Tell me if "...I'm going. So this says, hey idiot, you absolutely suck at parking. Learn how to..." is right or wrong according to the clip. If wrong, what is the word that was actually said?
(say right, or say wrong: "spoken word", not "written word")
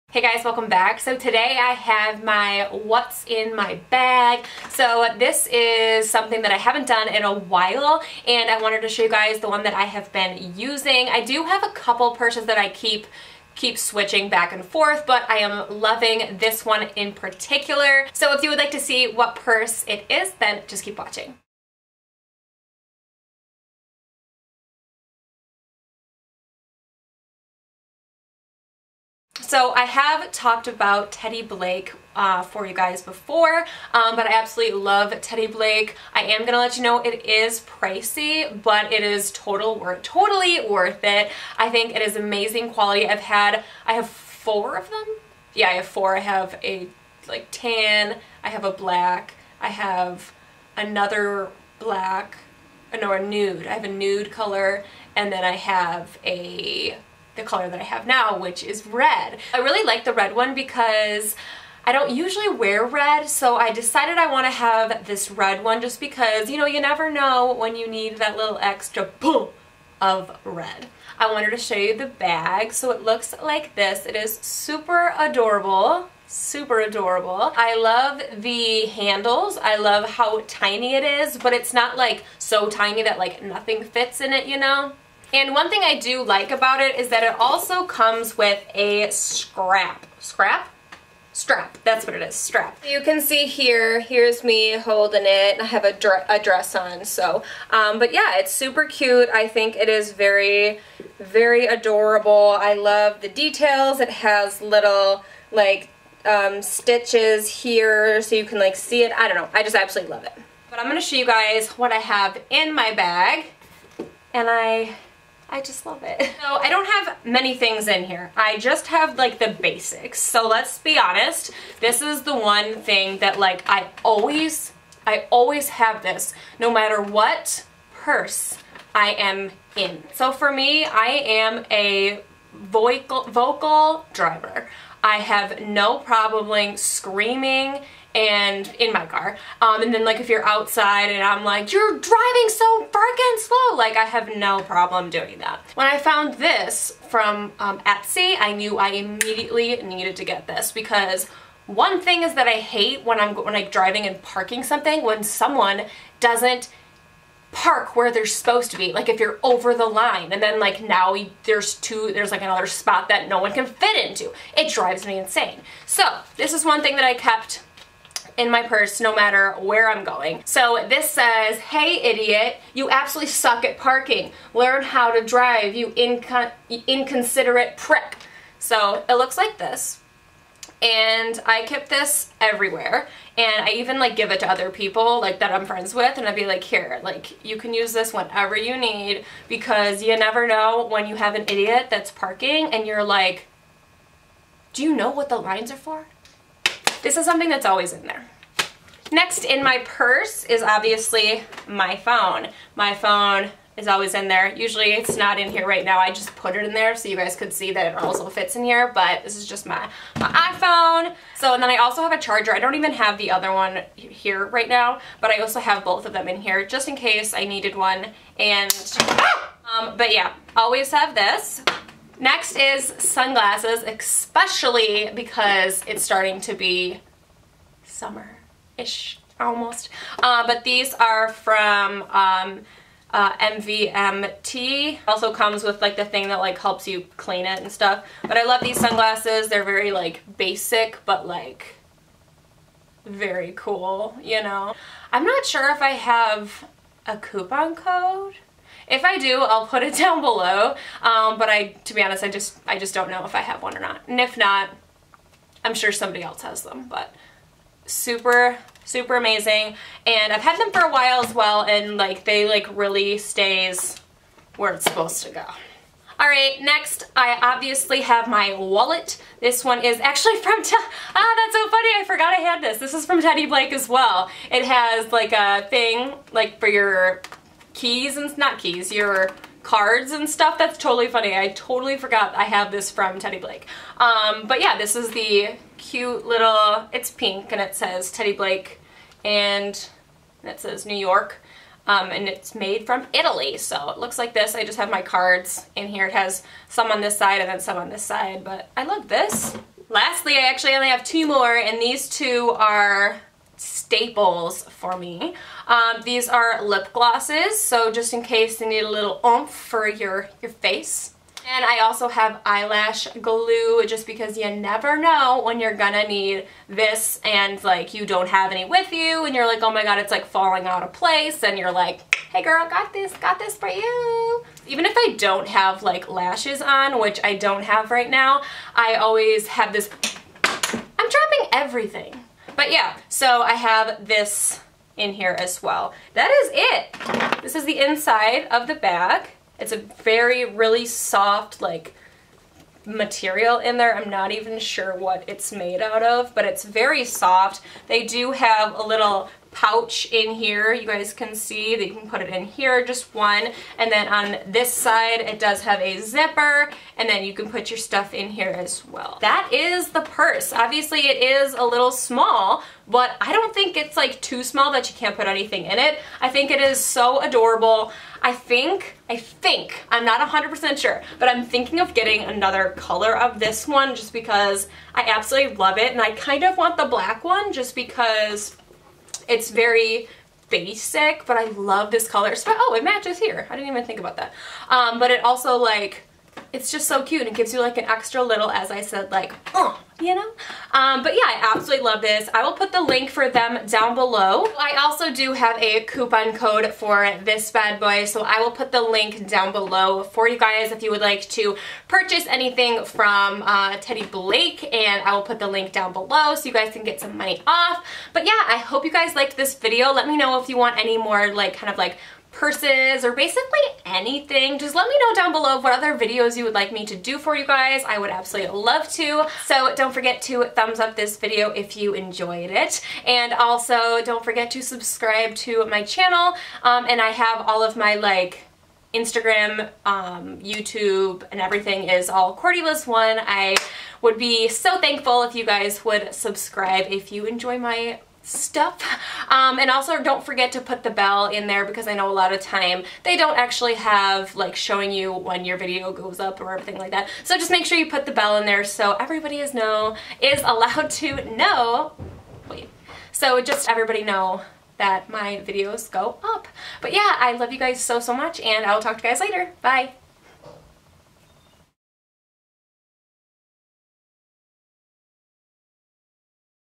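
right.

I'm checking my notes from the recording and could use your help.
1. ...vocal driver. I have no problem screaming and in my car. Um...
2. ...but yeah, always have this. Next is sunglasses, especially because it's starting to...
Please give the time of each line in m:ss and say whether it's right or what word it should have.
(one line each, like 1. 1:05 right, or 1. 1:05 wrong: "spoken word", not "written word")
1. 2:13 right
2. 3:39 right.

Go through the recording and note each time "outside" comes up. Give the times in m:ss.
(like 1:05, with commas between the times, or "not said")
2:20.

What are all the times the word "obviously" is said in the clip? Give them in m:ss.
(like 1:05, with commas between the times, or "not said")
3:20, 4:27, 6:00.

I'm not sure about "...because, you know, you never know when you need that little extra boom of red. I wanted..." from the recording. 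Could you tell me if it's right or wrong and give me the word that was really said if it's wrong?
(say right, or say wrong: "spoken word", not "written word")
right.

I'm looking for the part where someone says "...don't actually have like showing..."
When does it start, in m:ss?
7:23.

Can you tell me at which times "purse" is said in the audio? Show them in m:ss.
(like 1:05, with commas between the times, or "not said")
0:12, 0:19, 2:07, 2:48, 3:19, 6:00, 6:52.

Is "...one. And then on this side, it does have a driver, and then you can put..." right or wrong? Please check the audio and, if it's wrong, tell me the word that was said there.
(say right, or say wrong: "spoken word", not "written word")
wrong: "zipper", not "driver".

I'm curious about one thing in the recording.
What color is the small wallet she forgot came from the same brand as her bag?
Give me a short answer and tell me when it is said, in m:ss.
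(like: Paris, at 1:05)
Pink, at 4:47.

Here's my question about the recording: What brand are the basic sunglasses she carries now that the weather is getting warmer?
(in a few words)
MVMT.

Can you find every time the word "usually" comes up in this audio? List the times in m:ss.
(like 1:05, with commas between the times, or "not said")
1:02, 3:24.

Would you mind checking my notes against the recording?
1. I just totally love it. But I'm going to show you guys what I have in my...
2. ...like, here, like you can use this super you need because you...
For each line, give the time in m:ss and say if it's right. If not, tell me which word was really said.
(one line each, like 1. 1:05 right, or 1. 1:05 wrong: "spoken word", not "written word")
1. 1:49 wrong: "absolutely", not "totally"
2. 3:06 wrong: "whenever", not "super".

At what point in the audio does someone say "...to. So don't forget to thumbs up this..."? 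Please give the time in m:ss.
6:58.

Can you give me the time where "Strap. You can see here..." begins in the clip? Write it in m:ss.
1:32.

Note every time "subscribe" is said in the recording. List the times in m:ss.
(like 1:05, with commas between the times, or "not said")
7:04, 7:16.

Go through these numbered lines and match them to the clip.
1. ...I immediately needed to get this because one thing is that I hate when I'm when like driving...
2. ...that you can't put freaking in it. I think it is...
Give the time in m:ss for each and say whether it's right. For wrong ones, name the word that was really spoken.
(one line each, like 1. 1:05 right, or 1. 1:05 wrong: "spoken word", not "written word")
1. 2:28 right
2. 6:04 wrong: "anything", not "freaking".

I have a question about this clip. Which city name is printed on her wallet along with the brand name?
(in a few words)
New York.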